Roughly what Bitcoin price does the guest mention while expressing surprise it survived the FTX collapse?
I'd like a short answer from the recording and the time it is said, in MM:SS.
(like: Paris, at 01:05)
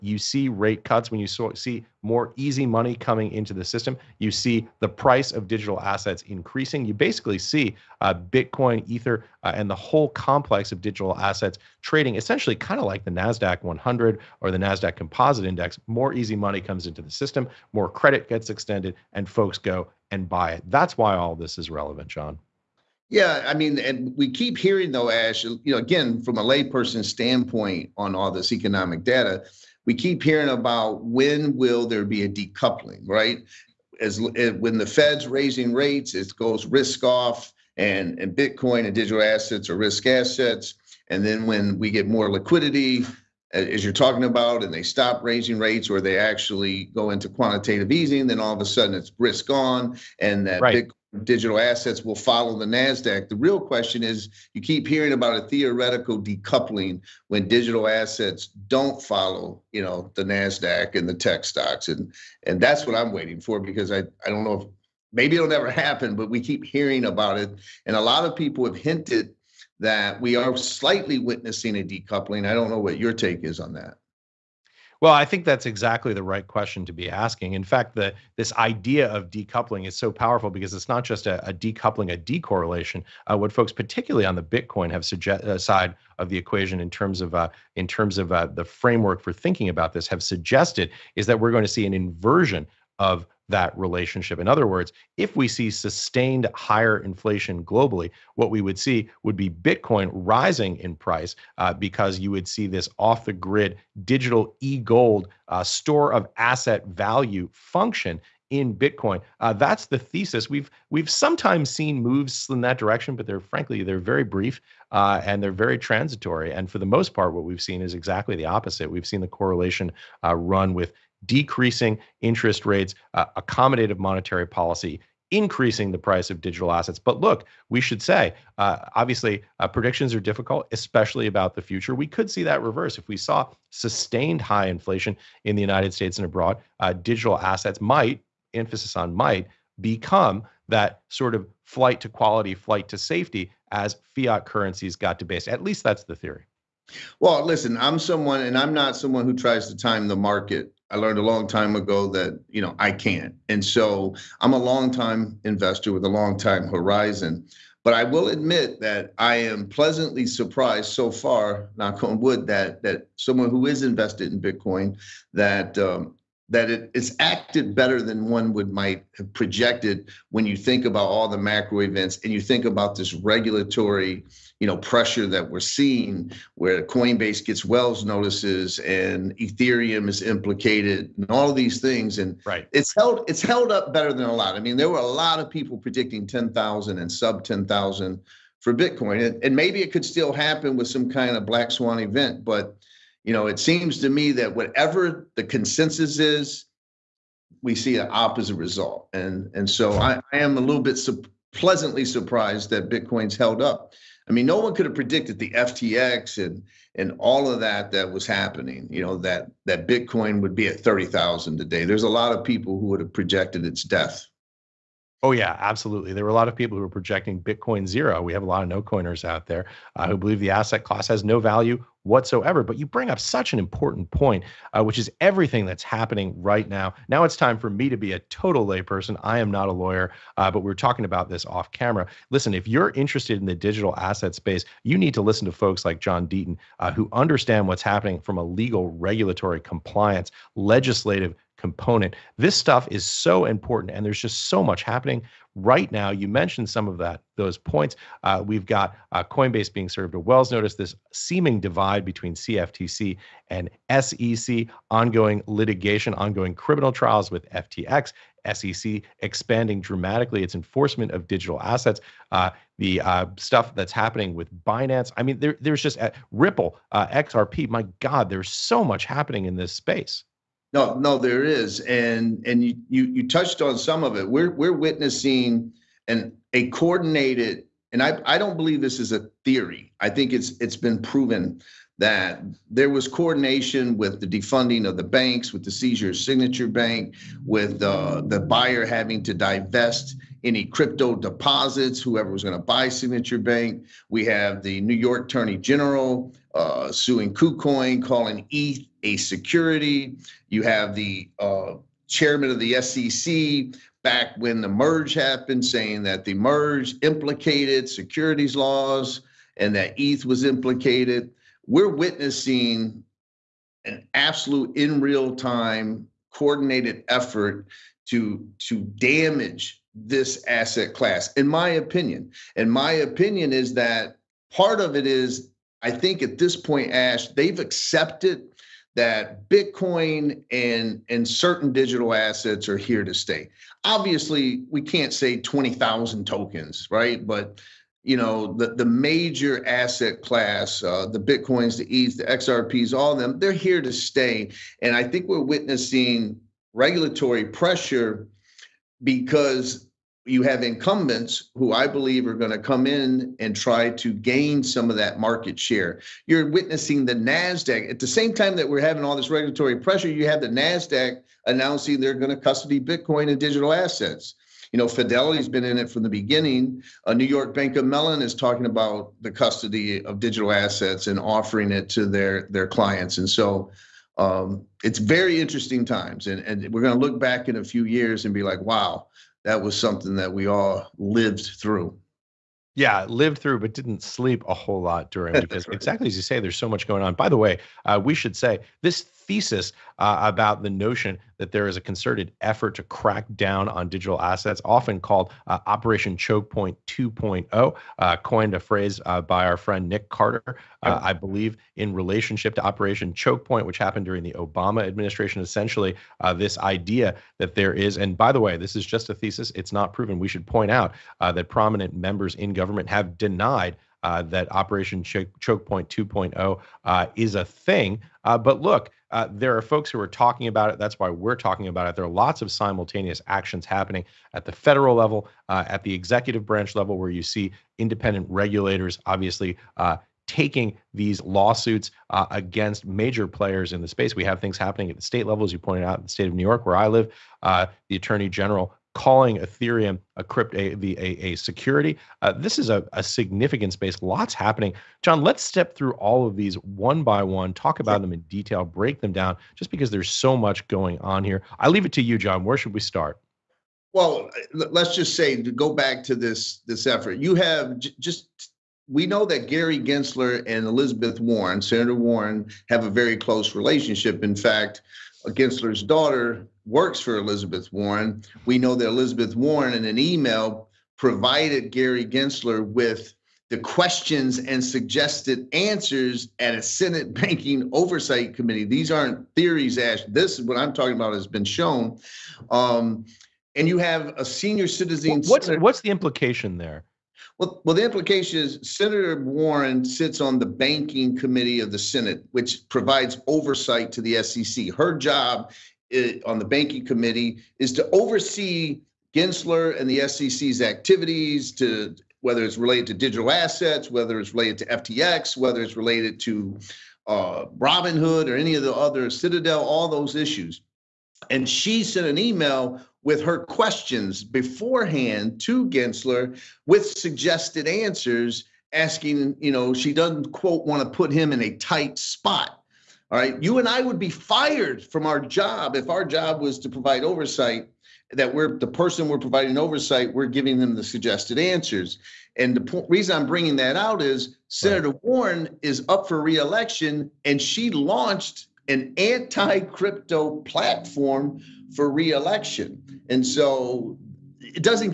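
30,000, at 03:30.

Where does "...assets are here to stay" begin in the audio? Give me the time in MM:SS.
05:32.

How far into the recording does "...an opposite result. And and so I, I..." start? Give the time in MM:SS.
03:17.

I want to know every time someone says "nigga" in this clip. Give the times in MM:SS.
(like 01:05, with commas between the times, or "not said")
not said.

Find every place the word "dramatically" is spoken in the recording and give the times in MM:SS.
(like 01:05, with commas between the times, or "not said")
04:19.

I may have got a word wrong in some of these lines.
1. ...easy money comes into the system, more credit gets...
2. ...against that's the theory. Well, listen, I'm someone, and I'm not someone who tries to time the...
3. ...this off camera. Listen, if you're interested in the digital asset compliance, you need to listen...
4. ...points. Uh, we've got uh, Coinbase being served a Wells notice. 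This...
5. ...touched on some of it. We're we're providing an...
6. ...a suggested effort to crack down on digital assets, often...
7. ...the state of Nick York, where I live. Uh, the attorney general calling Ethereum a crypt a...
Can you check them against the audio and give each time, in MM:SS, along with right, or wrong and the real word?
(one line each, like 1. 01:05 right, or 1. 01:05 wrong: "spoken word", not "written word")
1. 00:16 right
2. 02:25 wrong: "least", not "against"
3. 03:51 wrong: "space", not "compliance"
4. 04:07 right
5. 04:33 wrong: "witnessing", not "providing"
6. 06:31 wrong: "concerted", not "suggested"
7. 07:16 wrong: "New", not "Nick".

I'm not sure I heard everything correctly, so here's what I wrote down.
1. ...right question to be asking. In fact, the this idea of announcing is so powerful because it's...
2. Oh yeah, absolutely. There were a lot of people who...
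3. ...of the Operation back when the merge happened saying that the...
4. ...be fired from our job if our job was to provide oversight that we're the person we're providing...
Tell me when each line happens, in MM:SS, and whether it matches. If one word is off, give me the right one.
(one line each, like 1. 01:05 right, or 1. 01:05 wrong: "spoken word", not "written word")
1. 01:16 wrong: "decoupling", not "announcing"
2. 03:35 right
3. 05:02 wrong: "SEC", not "Operation"
4. 08:43 right.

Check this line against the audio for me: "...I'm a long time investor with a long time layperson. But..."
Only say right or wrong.
wrong.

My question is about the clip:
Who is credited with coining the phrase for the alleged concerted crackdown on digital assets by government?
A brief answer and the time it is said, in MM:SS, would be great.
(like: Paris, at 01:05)
Nick Carter, at 06:39.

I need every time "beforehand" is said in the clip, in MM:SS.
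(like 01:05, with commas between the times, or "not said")
08:34.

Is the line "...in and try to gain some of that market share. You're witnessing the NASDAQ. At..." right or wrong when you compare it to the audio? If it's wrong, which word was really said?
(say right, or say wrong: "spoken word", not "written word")
right.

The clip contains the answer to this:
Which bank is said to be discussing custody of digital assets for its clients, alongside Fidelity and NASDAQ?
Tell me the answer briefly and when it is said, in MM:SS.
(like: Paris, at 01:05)
New York Bank of Mellon, at 06:07.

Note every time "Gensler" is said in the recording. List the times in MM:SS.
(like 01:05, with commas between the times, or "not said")
07:39, 07:45, 07:52, 08:19, 08:35.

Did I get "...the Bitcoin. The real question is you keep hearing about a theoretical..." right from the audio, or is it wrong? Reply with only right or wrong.
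wrong.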